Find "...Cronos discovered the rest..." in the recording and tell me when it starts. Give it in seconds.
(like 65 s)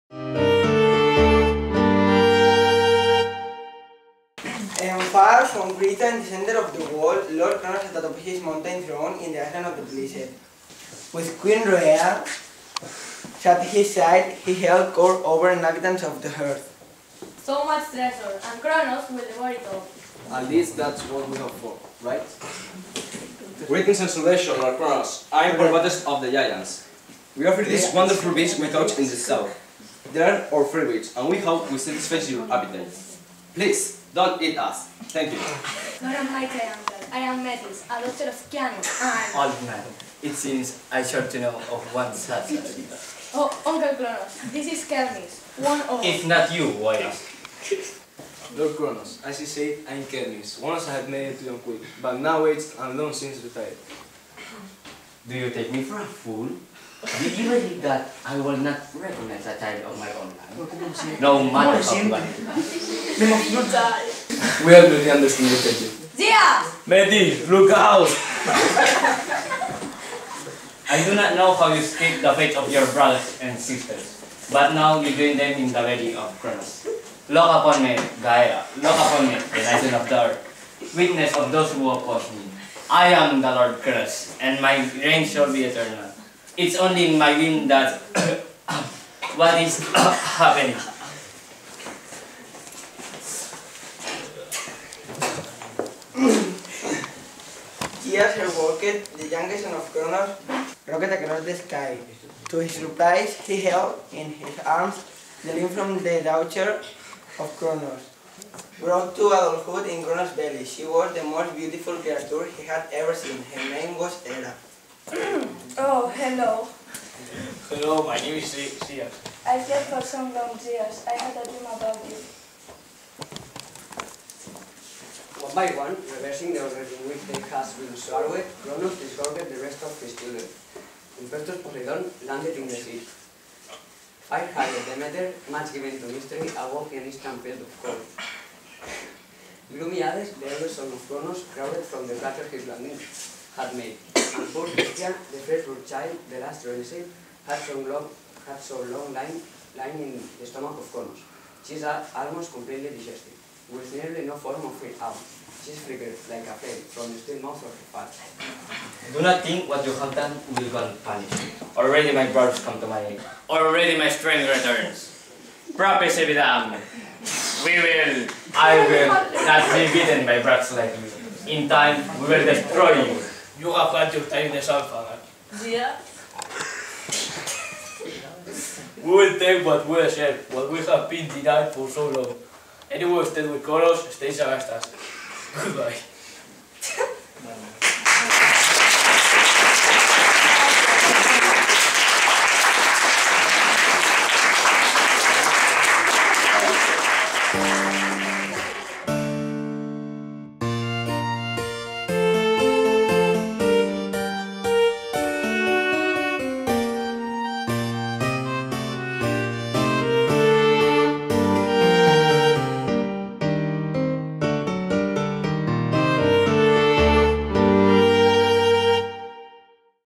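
128 s.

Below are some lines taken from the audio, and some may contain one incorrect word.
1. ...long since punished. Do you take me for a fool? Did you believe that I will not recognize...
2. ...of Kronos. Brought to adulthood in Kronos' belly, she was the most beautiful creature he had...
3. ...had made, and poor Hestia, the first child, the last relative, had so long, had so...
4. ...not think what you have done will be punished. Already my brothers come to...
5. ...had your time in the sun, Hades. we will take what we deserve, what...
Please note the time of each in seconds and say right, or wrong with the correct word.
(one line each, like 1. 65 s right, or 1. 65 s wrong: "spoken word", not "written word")
1. 52 s wrong: "retired", not "punished"
2. 107 s right
3. 143 s right
4. 159 s right
5. 173 s wrong: "Yeah", not "Hades".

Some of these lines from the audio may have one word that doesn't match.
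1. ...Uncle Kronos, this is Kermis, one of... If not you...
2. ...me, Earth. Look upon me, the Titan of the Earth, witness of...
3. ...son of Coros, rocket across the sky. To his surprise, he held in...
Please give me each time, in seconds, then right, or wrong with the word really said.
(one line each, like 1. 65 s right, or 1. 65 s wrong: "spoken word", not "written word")
1. 43 s right
2. 77 s wrong: "Gaia", not "Earth"
3. 99 s wrong: "Kronos", not "Coros".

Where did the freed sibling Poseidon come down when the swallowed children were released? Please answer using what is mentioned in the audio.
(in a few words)
In the sea.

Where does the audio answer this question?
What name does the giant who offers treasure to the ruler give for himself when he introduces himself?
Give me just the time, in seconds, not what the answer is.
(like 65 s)
25 s.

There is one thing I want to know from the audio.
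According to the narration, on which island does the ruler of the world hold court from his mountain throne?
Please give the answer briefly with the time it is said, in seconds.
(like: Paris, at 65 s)
The island of the Blessed, at 9 s.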